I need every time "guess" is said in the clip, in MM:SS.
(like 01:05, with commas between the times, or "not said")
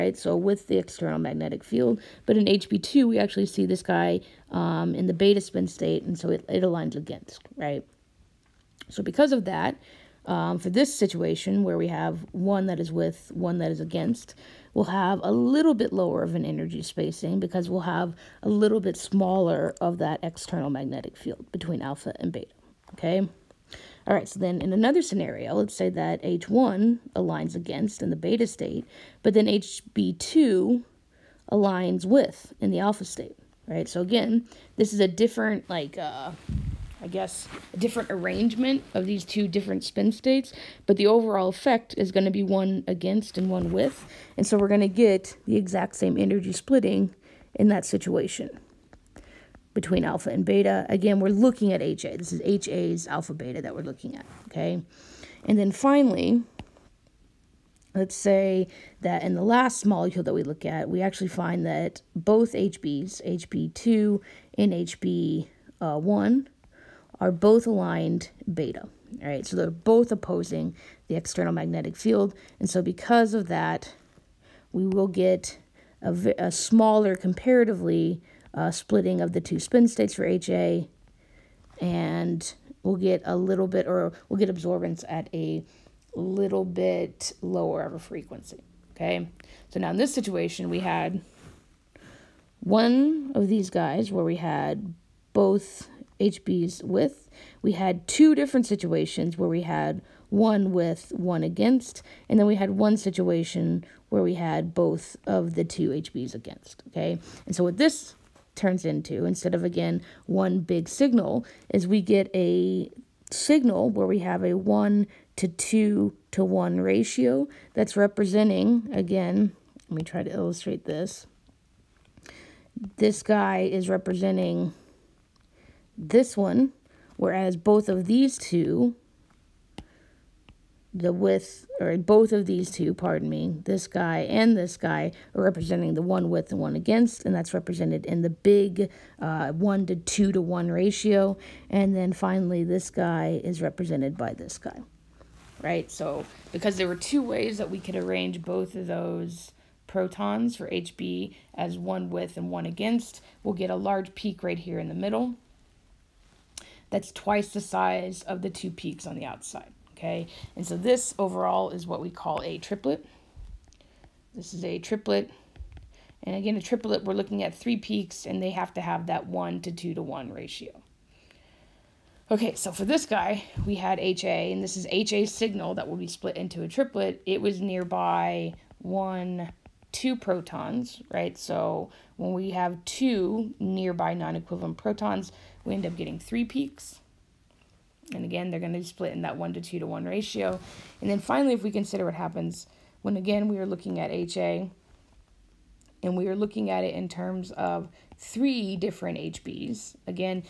00:37.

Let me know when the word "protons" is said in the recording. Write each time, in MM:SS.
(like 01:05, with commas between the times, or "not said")
02:29, 03:00, 03:04.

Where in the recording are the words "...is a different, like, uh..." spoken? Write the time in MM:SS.
00:34.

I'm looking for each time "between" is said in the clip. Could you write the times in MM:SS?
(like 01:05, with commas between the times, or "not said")
00:21, 00:49.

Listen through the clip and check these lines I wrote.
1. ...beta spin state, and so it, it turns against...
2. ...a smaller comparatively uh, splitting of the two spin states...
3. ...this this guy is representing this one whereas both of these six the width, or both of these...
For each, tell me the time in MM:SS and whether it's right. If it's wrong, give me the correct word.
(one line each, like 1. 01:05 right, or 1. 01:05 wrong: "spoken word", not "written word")
1. 00:05 wrong: "aligns", not "turns"
2. 01:16 right
3. 02:00 wrong: "two", not "six".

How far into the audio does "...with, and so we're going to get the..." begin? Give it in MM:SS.
00:43.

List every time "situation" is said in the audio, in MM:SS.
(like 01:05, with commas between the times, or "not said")
00:10, 00:47, 01:30, 01:38, 01:42.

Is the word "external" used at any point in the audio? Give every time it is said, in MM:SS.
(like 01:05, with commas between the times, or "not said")
00:00, 00:20, 01:11.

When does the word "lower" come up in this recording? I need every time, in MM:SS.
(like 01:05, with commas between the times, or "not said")
00:15, 01:27.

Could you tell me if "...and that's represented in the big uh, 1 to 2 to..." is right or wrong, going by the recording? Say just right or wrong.
right.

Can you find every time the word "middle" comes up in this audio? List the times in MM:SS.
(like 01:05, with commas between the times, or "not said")
02:34.